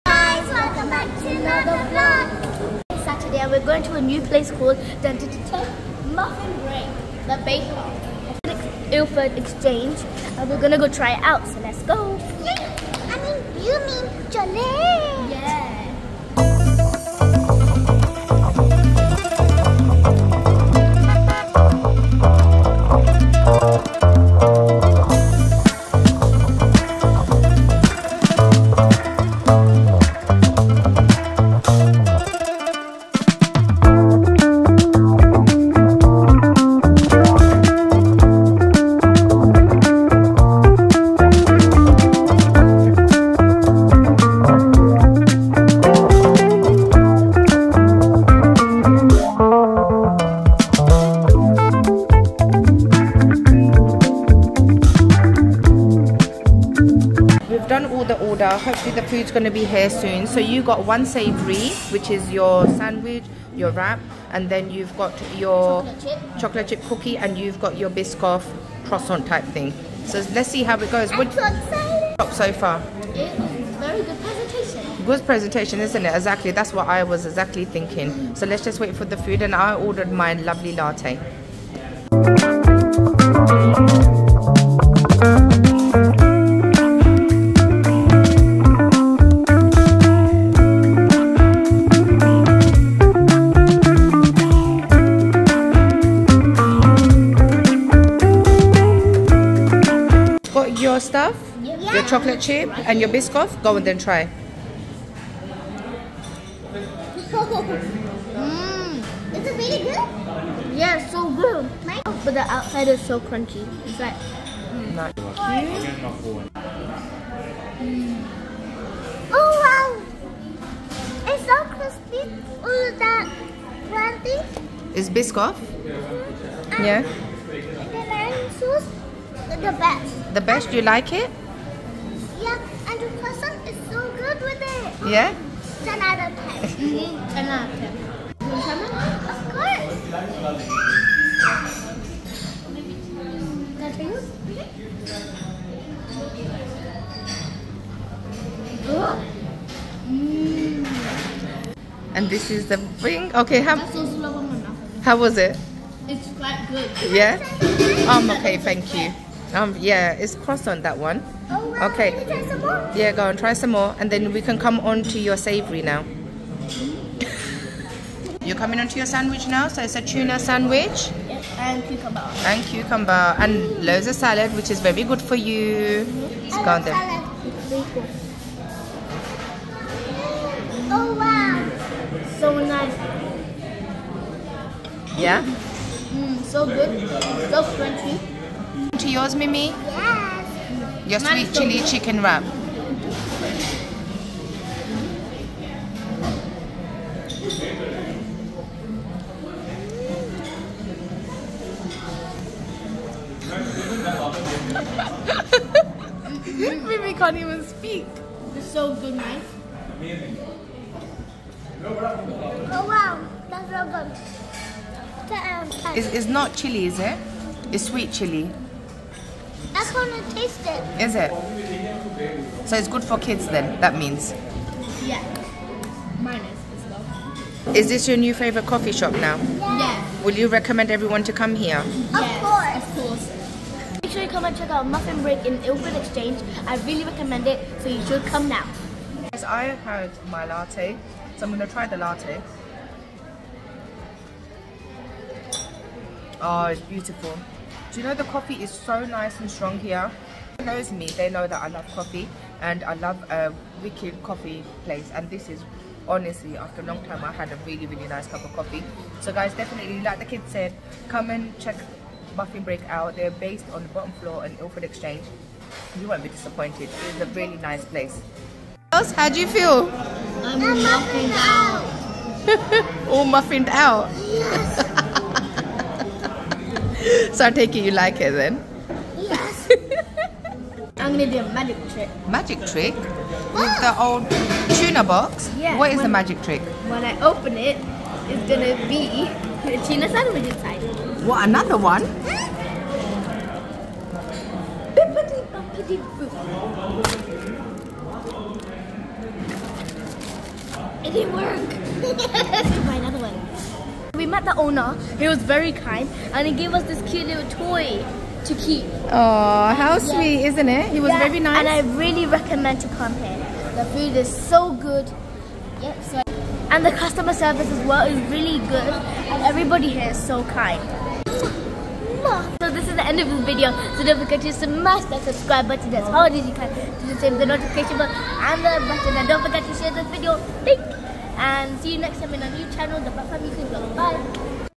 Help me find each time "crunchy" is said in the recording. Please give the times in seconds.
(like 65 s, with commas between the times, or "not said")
113 s, 123 s, 187 s.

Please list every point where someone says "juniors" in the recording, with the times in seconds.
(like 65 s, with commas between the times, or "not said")
not said.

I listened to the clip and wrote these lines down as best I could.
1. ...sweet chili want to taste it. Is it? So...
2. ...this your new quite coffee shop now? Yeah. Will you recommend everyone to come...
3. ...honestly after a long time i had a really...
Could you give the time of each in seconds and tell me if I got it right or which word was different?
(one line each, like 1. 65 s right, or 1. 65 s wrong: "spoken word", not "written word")
1. 217 s right
2. 227 s wrong: "favorite", not "quite"
3. 256 s right.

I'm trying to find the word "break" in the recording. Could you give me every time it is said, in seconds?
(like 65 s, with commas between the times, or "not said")
6 s, 235 s, 262 s.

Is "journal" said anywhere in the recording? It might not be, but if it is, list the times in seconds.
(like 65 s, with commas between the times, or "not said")
not said.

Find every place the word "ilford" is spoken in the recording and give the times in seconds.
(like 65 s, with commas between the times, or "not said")
8 s, 235 s, 264 s.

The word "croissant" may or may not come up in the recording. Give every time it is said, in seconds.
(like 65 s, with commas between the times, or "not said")
68 s, 133 s.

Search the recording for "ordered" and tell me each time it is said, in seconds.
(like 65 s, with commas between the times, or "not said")
79 s.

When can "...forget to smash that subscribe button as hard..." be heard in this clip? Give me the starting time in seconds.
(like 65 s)
324 s.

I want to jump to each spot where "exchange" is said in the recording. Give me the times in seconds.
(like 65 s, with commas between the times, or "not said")
9 s, 235 s, 264 s.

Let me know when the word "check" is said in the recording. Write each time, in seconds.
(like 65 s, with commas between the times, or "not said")
234 s, 261 s.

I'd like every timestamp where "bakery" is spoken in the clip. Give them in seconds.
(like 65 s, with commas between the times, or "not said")
7 s.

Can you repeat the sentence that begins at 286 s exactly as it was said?
When I open it, it's gonna be a tuna sandwich inside.